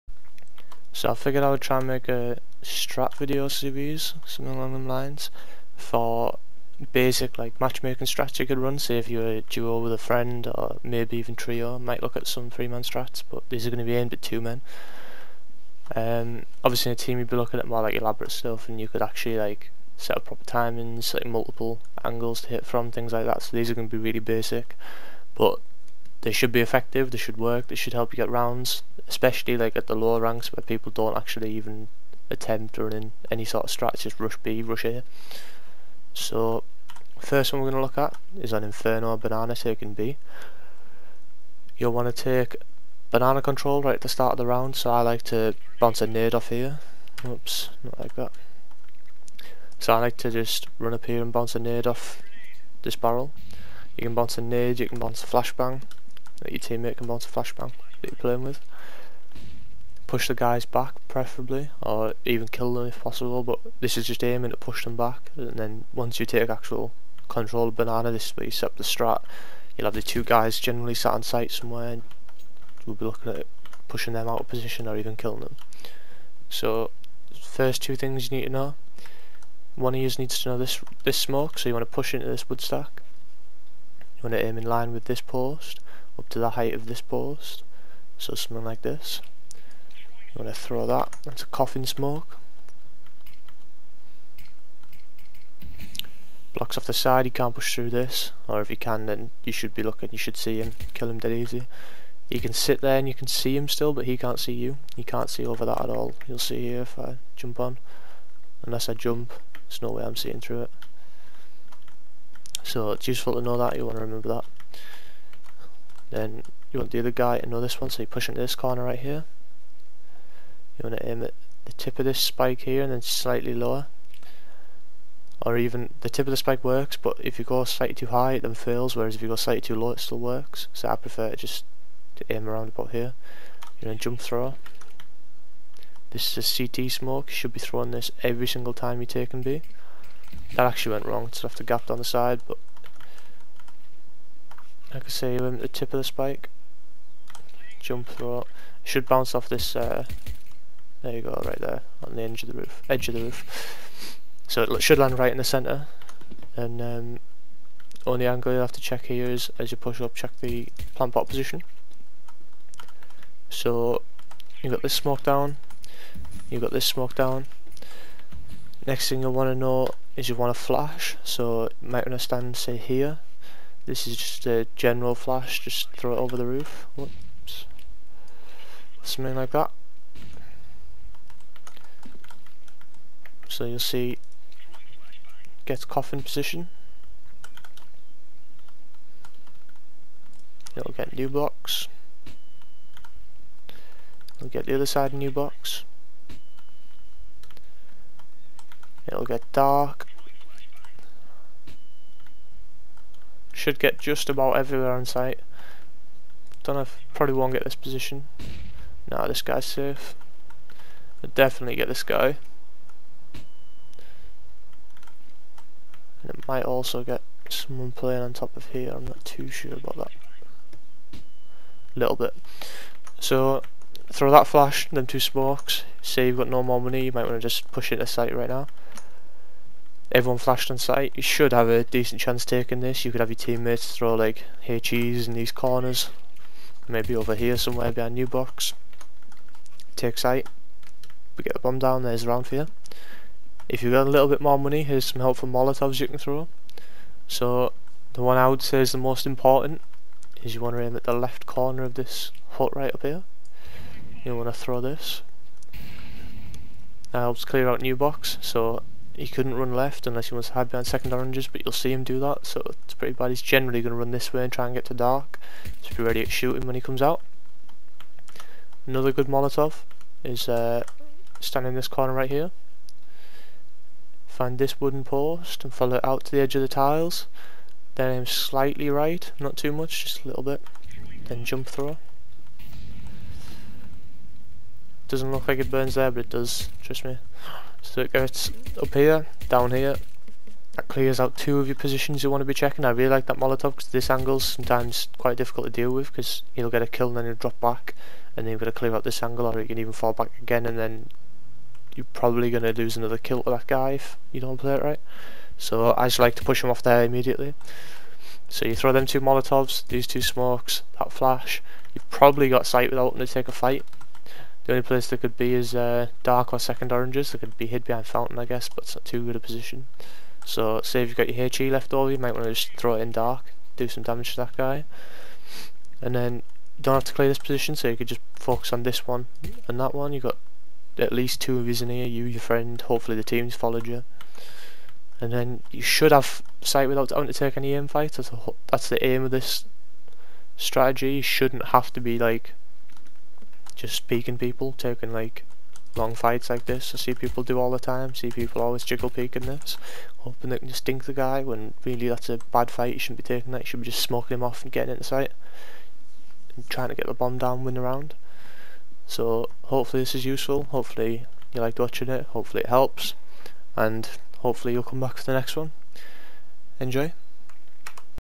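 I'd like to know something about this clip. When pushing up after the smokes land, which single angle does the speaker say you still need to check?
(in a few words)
Plant pot.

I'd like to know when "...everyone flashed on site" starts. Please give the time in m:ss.
3:50.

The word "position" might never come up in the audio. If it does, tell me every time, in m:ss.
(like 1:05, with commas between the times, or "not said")
1:14, 2:41, 3:06, 3:27, 4:51, 5:19, 5:27.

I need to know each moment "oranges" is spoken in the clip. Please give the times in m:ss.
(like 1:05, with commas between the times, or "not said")
4:21, 5:16.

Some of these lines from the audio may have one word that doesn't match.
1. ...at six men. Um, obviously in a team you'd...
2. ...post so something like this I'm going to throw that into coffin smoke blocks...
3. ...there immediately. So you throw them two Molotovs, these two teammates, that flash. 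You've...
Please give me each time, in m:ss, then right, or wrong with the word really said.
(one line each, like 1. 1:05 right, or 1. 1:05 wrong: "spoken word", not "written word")
1. 0:14 wrong: "two", not "six"
2. 1:27 right
3. 5:06 wrong: "smokes", not "teammates".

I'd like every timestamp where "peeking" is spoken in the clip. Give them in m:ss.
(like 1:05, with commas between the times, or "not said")
5:44, 5:49.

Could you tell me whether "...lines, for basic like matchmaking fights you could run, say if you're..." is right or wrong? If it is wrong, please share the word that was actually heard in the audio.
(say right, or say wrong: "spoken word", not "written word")
wrong: "strats", not "fights".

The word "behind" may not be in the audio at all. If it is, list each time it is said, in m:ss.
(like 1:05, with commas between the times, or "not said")
3:57, 4:20, 5:17.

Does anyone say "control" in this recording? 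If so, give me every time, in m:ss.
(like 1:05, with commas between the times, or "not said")
0:43, 1:07.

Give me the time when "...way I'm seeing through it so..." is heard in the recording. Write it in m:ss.
1:49.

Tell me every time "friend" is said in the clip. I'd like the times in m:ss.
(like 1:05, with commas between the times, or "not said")
0:09, 5:32.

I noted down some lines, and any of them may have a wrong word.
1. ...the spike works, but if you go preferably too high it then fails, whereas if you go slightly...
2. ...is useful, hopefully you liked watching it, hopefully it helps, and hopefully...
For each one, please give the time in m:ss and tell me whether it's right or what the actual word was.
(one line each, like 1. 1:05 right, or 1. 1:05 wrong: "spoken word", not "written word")
1. 2:06 wrong: "slightly", not "preferably"
2. 6:00 right.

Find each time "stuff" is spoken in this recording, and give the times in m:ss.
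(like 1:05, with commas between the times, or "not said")
0:18.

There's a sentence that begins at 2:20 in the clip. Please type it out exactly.
That actually went wrong, It's left a gap down the side, but I can see him at the tip of the spike.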